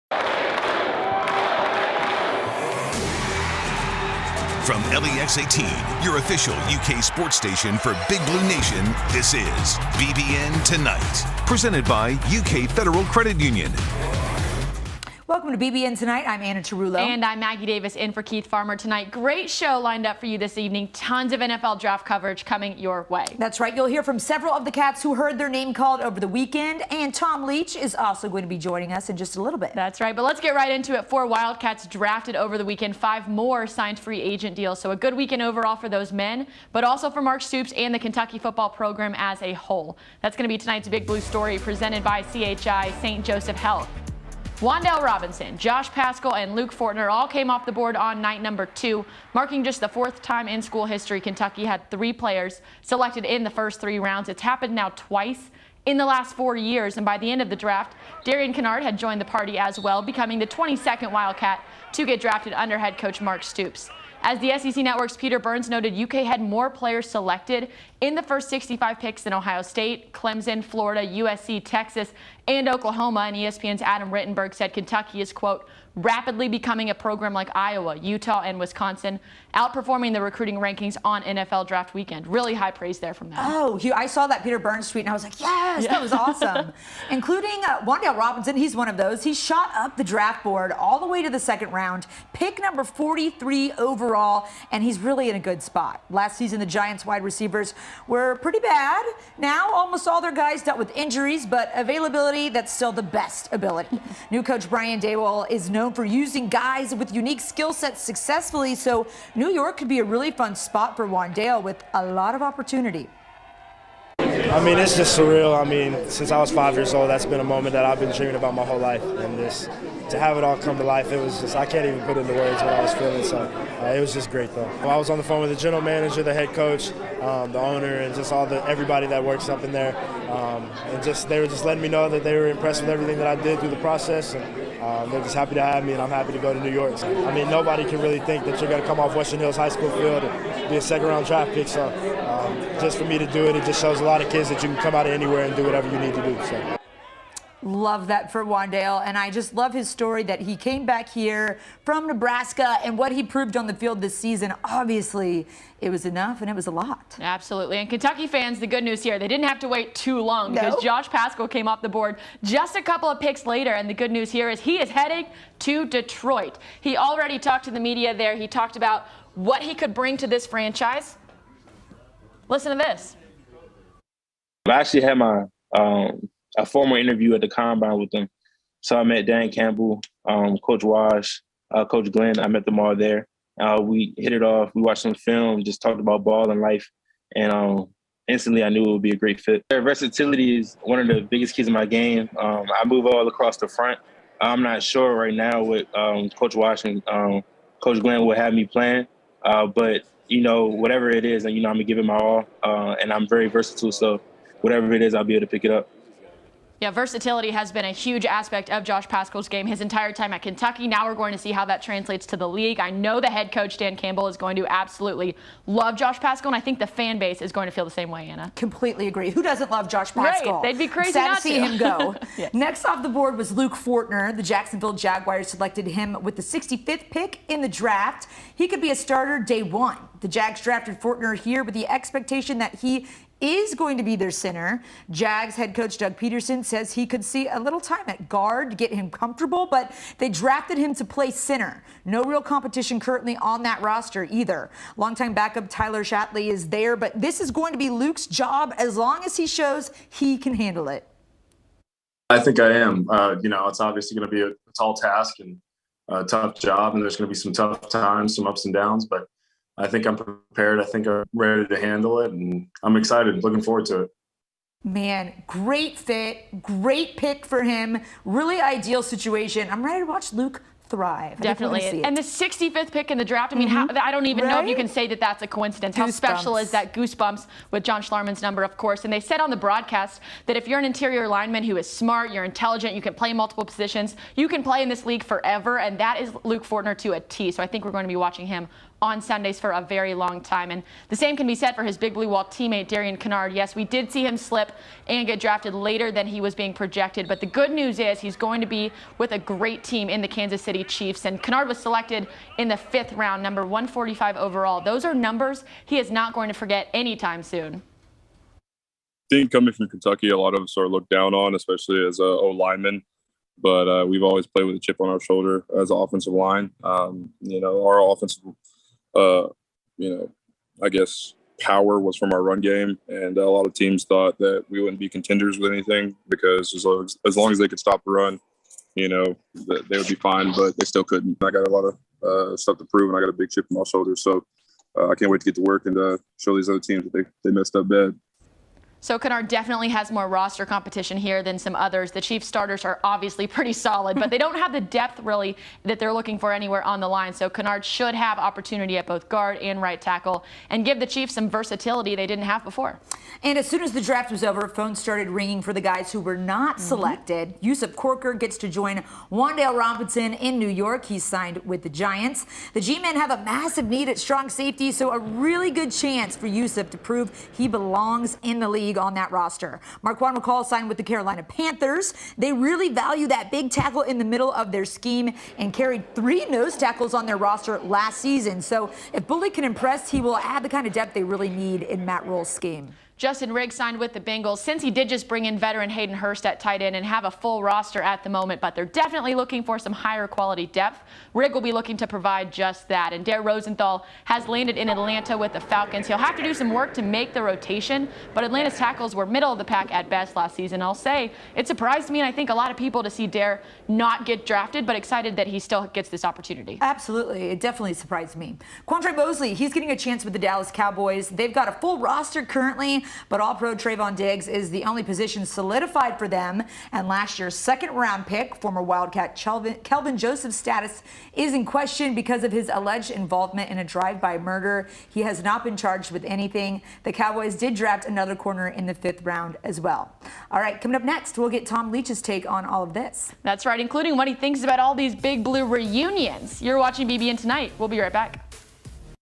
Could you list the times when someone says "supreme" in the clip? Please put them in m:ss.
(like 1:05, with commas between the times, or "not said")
not said.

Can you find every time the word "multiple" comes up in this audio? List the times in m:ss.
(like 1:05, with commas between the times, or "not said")
4:43.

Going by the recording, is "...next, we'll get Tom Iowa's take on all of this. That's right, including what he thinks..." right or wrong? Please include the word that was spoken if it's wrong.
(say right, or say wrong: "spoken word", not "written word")
wrong: "Leach", not "Iowa".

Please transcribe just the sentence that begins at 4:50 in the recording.
And the same can be said for his Big Blue Wall teammate, Darian Kinnard.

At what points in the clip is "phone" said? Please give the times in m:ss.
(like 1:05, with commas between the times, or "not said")
2:05, 5:54.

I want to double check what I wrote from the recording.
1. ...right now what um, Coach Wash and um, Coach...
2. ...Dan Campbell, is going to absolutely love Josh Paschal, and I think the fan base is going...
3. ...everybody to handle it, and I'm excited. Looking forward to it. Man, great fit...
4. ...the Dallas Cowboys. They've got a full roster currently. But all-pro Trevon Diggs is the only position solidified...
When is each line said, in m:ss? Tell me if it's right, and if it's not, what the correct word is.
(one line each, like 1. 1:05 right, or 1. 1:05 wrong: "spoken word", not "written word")
1. 3:15 right
2. 3:33 right
3. 4:21 wrong: "ready", not "everybody"
4. 6:50 right.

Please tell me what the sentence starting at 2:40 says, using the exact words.
Josh Paschal came off the board just a couple of picks later.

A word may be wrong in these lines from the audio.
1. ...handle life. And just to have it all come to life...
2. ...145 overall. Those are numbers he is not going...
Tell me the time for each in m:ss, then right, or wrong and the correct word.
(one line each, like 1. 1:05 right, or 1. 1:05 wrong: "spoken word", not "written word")
1. 1:58 wrong: "whole", not "handle"
2. 5:03 right.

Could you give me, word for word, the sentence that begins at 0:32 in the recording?
Five more signed free agent deals.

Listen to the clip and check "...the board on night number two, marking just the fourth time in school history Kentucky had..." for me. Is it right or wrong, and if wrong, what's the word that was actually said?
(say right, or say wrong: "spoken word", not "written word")
right.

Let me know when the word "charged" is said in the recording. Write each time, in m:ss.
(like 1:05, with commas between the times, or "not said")
7:05.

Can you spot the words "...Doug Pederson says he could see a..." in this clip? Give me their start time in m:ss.
3:55.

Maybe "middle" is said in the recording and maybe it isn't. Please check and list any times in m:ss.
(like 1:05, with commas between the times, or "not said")
6:14, 6:39.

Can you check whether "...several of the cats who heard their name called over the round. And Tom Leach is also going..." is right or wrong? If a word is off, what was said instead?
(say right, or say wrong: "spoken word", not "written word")
wrong: "weekend", not "round".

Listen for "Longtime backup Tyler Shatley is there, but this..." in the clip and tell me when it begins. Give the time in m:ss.
4:04.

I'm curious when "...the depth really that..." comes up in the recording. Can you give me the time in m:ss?
5:44.